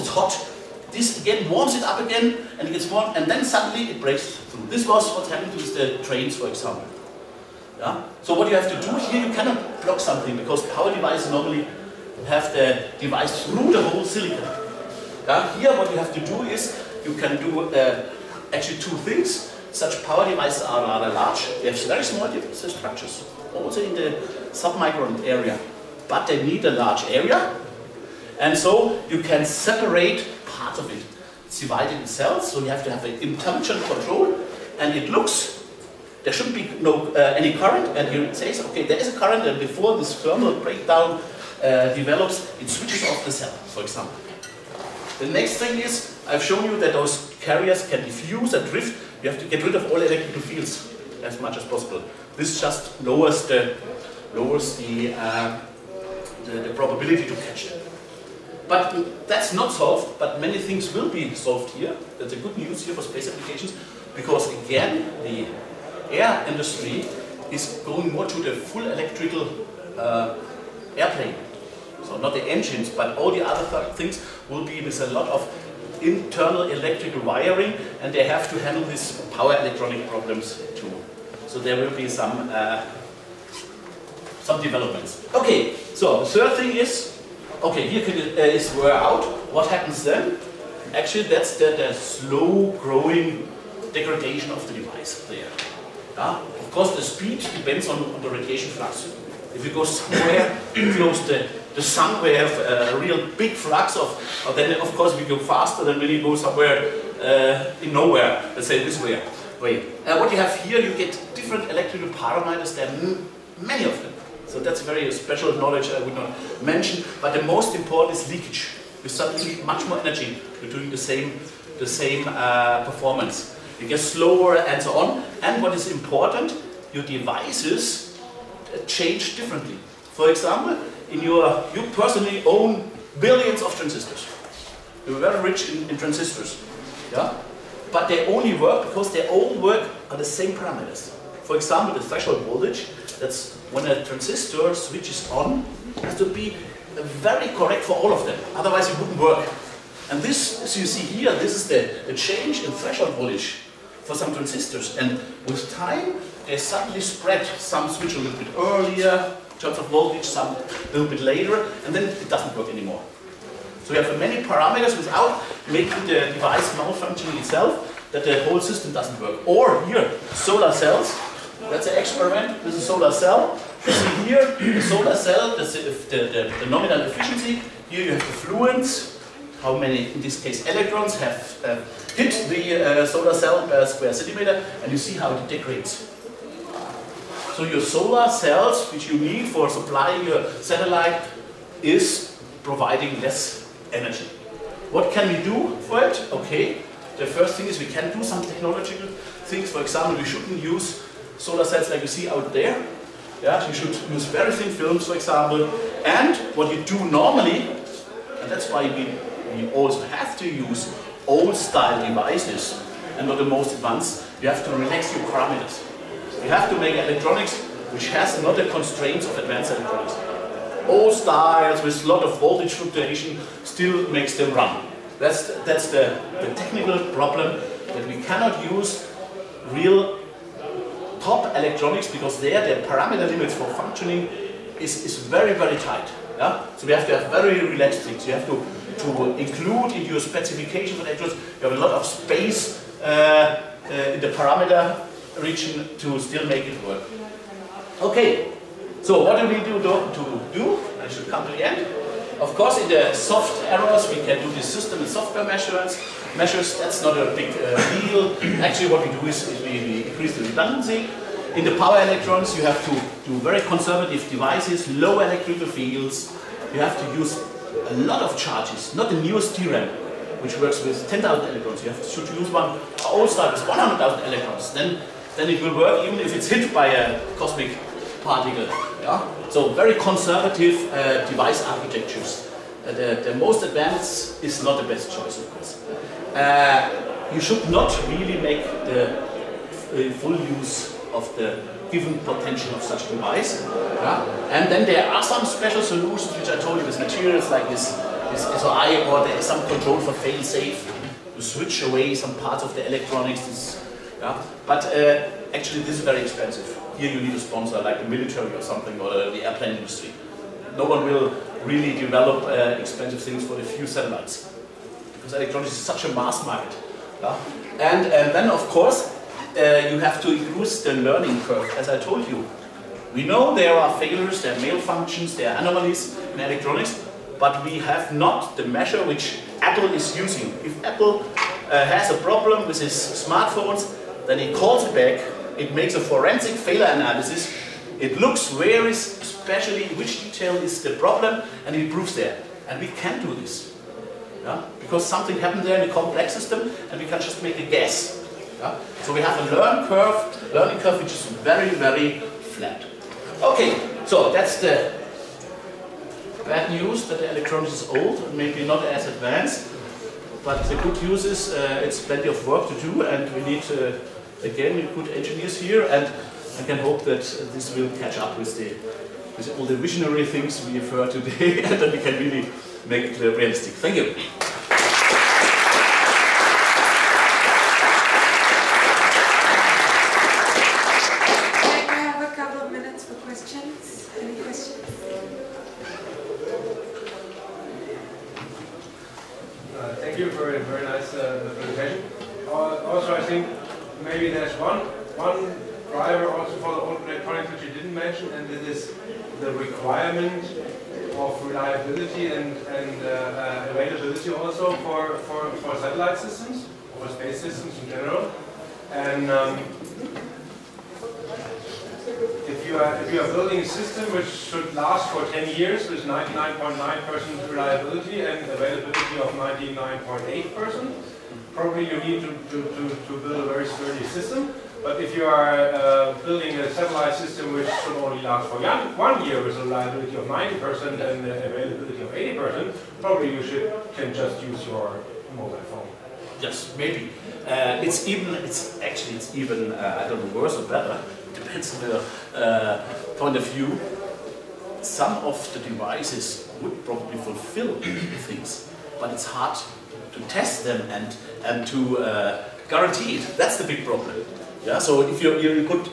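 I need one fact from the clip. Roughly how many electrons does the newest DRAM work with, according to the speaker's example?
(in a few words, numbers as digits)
10,000.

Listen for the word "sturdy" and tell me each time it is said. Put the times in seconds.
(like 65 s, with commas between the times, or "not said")
423 s.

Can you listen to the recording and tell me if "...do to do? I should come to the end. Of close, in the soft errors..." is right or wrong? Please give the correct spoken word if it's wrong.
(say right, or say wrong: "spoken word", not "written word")
wrong: "course", not "close".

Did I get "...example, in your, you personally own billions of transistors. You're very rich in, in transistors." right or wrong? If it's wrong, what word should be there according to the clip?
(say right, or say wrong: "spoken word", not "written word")
right.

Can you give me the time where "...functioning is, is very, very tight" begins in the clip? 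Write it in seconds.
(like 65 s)
233 s.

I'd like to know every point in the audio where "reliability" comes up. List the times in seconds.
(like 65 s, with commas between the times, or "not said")
417 s, 429 s.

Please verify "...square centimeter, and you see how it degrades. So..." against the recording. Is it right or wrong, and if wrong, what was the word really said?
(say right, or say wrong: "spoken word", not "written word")
right.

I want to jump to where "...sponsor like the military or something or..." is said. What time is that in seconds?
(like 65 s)
307 s.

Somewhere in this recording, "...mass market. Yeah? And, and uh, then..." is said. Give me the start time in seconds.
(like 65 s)
316 s.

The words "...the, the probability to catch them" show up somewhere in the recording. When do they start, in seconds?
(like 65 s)
56 s.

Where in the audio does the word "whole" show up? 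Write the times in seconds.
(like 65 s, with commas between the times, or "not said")
13 s, 168 s.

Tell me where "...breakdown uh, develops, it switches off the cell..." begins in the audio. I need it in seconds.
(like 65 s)
40 s.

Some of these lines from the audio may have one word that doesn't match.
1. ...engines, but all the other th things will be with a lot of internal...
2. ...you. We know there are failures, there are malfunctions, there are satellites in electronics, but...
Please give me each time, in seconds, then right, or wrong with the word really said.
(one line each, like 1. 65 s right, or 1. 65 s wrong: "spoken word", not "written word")
1. 72 s right
2. 322 s wrong: "anomalies", not "satellites".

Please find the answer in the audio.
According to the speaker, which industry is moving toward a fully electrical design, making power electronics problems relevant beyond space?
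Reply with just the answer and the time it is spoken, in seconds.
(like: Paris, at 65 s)
air industry, at 65 s.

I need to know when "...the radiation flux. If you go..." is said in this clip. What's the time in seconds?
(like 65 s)
98 s.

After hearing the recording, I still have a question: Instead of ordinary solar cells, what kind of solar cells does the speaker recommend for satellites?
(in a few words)
very thin films.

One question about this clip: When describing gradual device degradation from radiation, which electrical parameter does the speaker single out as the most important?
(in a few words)
leakage.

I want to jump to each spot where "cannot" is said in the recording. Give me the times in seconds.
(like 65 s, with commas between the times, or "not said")
9 s, 228 s.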